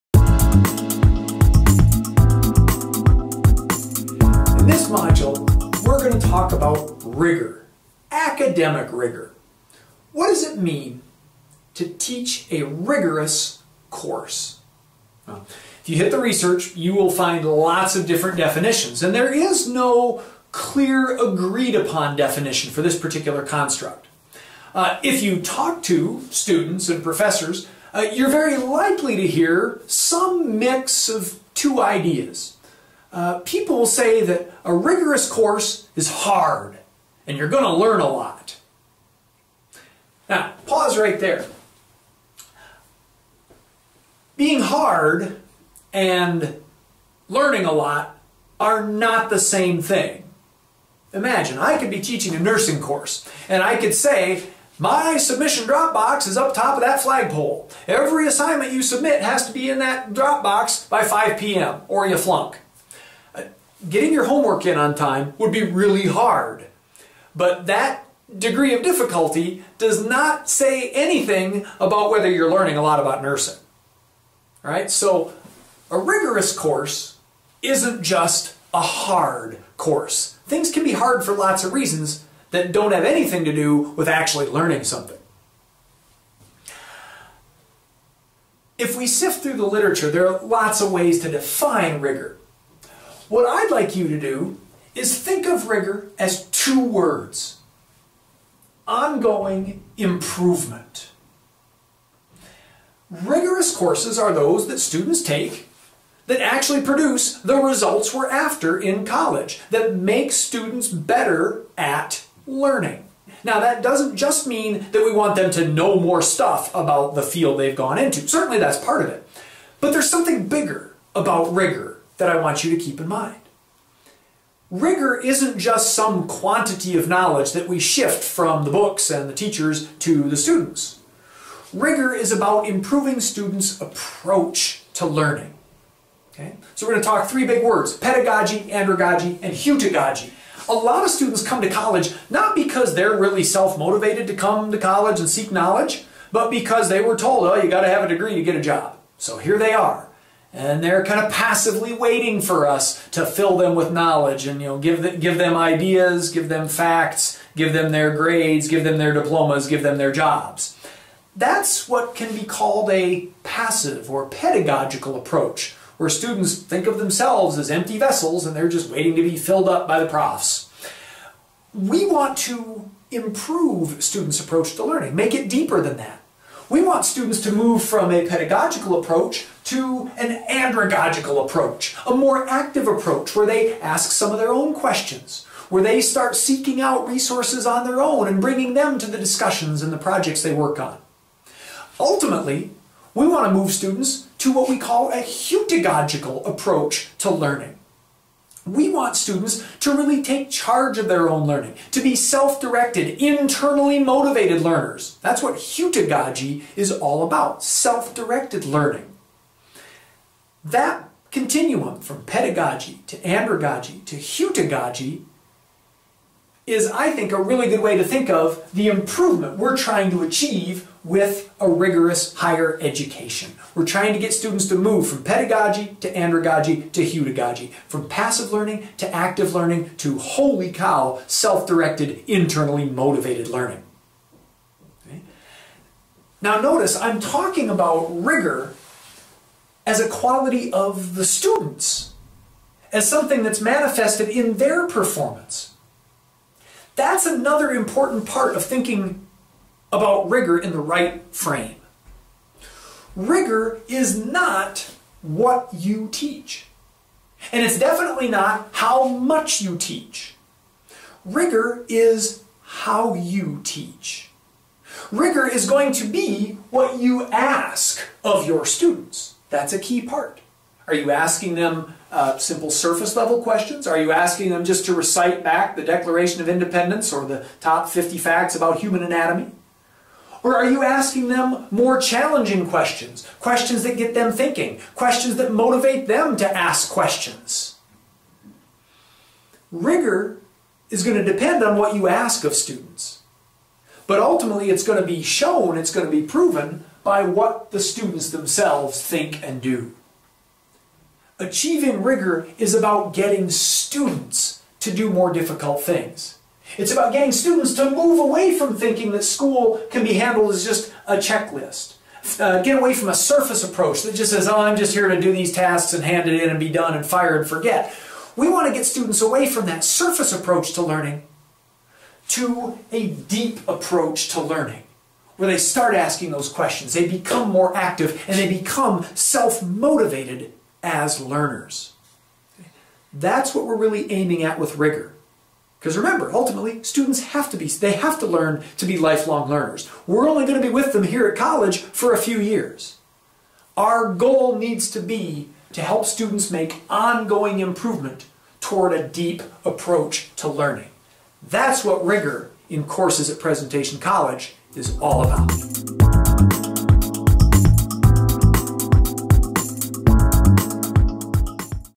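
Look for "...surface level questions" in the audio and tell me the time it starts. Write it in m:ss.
4:32.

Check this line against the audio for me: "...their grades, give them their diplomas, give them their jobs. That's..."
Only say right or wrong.
right.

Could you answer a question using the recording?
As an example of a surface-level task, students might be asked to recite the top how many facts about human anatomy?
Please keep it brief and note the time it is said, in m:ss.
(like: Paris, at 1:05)
50, at 4:37.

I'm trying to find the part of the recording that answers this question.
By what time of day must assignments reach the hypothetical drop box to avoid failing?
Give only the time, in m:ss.
1:01.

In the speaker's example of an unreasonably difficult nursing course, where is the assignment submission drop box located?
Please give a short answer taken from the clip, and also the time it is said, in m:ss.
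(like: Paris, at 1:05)
top of that flagpole, at 0:56.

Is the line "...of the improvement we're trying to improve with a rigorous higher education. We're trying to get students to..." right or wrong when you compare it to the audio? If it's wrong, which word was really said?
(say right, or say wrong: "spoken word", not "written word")
wrong: "achieve", not "improve".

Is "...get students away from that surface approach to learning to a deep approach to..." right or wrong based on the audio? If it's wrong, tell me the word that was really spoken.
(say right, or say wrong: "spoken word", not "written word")
right.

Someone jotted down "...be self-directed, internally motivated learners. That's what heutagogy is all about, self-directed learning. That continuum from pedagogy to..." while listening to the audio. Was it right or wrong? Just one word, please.
right.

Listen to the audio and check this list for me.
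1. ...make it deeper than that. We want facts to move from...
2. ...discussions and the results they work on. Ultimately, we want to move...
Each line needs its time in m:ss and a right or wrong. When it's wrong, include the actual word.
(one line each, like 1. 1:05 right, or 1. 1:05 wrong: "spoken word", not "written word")
1. 2:55 wrong: "students", not "facts"
2. 3:09 wrong: "projects", not "results".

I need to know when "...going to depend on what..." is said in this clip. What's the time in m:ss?
4:51.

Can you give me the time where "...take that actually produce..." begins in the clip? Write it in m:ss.
1:45.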